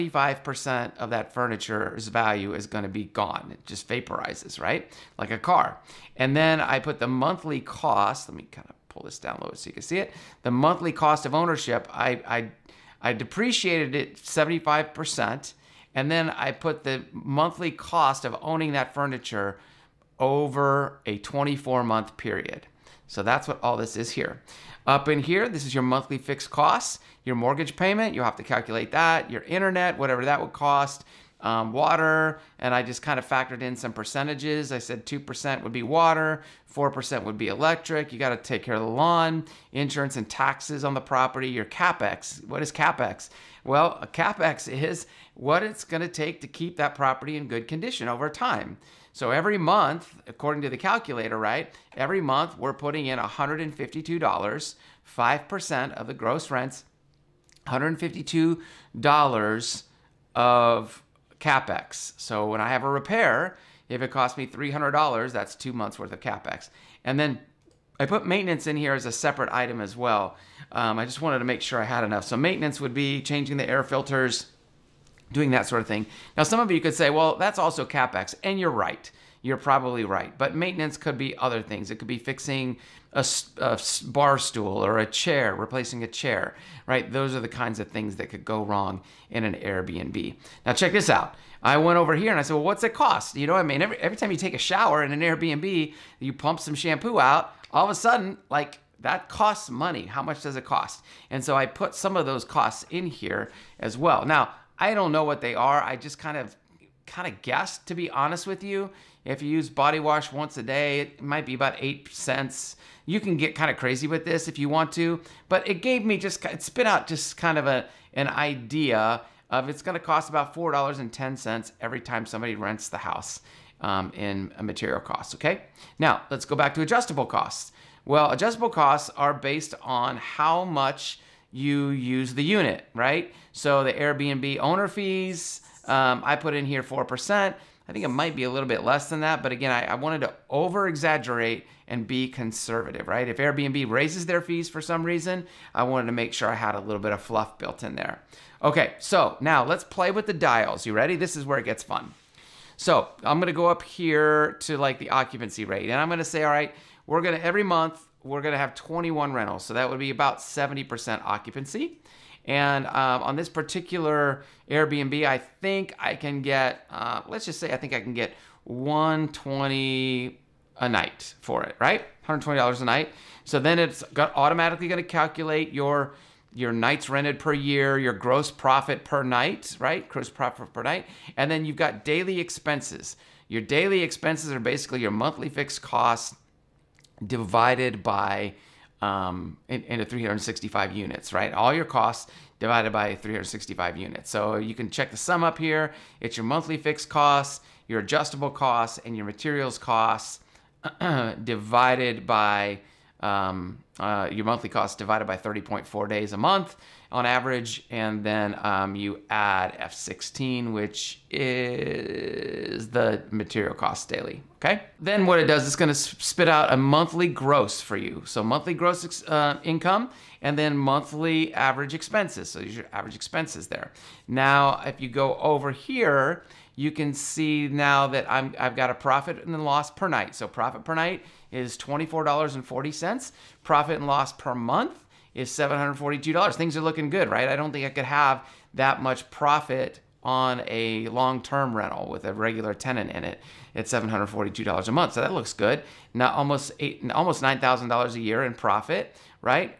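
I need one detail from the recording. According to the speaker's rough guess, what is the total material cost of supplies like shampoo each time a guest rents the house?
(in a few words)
$4.10.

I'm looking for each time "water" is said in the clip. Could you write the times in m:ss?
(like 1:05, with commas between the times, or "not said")
0:31, 0:35.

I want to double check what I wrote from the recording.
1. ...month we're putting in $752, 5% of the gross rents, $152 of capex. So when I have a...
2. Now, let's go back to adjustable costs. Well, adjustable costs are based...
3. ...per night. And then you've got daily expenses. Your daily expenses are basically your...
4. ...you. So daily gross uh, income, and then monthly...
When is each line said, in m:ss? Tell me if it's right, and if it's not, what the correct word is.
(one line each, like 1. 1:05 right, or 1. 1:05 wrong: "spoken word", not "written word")
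1. 0:52 wrong: "152", not "752"
2. 2:05 right
3. 3:00 right
4. 3:37 wrong: "monthly", not "daily".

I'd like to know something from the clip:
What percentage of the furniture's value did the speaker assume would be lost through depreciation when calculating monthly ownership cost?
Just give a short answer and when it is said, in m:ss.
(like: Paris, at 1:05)
75%, at 0:14.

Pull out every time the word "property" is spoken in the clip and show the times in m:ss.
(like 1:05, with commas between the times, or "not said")
0:41, 0:46.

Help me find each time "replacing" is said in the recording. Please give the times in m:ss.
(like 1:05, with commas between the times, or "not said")
1:25.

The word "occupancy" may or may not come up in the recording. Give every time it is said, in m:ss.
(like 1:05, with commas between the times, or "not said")
2:35, 2:41.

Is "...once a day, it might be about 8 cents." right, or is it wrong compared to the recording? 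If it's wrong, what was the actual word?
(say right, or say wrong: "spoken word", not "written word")
right.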